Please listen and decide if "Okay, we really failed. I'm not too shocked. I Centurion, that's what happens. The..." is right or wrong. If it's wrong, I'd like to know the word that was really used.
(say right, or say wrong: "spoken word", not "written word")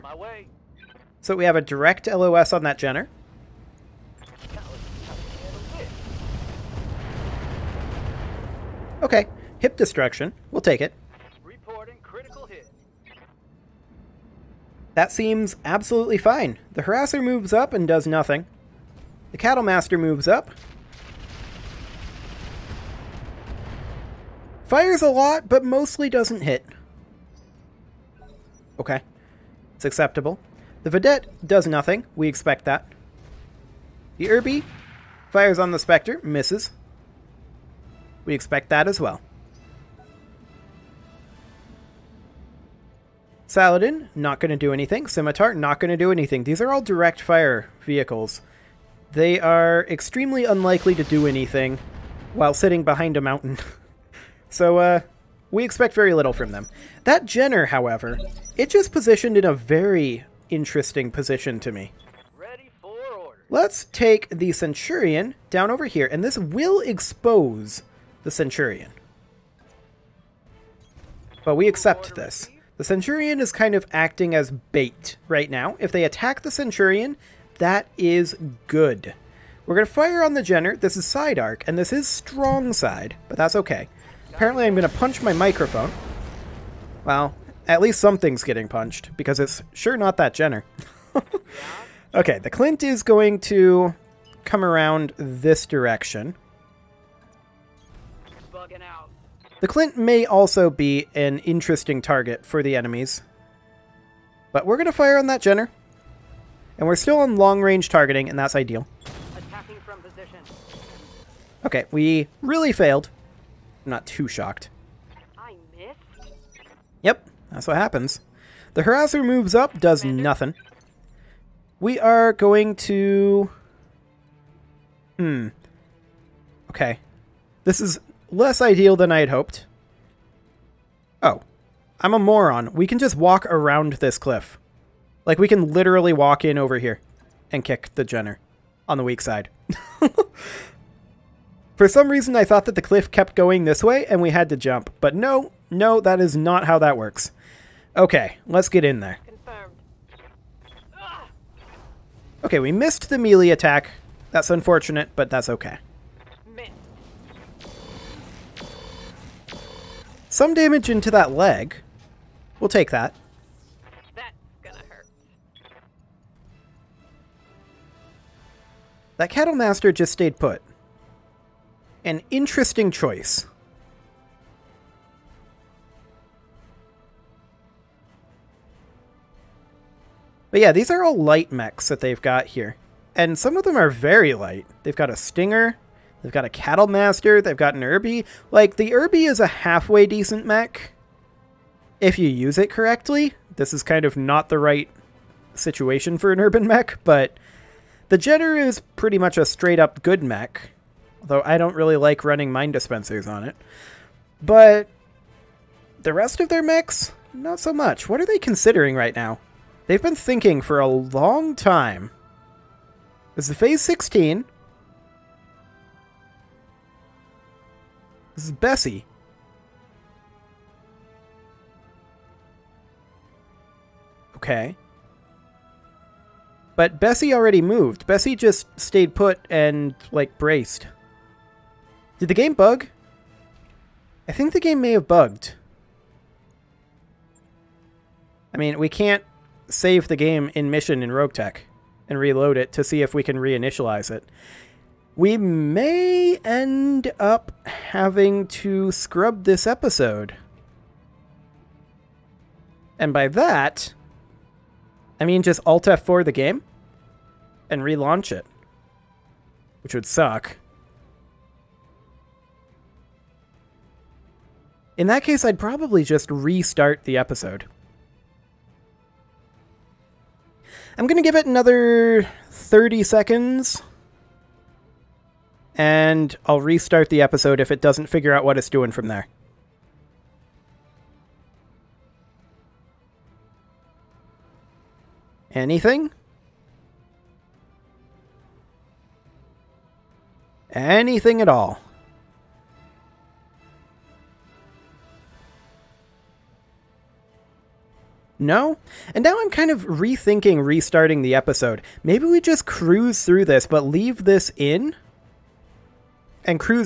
wrong: "Yep", not "Centurion".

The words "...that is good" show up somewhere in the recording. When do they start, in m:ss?
1:17.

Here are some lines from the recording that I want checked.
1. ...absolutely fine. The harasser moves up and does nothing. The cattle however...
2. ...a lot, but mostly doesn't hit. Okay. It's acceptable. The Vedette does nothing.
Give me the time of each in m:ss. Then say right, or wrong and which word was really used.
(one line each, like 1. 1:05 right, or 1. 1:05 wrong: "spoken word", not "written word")
1. 0:15 wrong: "master", not "however"
2. 0:25 right.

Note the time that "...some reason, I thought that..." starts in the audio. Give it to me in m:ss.
2:21.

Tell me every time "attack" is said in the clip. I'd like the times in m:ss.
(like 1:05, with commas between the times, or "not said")
1:16, 2:33.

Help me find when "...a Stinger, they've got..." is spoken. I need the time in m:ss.
3:05.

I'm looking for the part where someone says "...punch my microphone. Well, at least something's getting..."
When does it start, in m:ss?
1:24.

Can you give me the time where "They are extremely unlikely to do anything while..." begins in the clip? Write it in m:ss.
0:49.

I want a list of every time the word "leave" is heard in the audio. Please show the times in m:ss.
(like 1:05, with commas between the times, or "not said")
5:03.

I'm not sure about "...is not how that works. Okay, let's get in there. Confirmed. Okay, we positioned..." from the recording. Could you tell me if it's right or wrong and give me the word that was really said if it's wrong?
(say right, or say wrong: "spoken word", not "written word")
wrong: "missed", not "positioned".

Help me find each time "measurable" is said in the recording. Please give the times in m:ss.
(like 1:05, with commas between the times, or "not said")
not said.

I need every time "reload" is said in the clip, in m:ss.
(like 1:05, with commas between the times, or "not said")
4:02.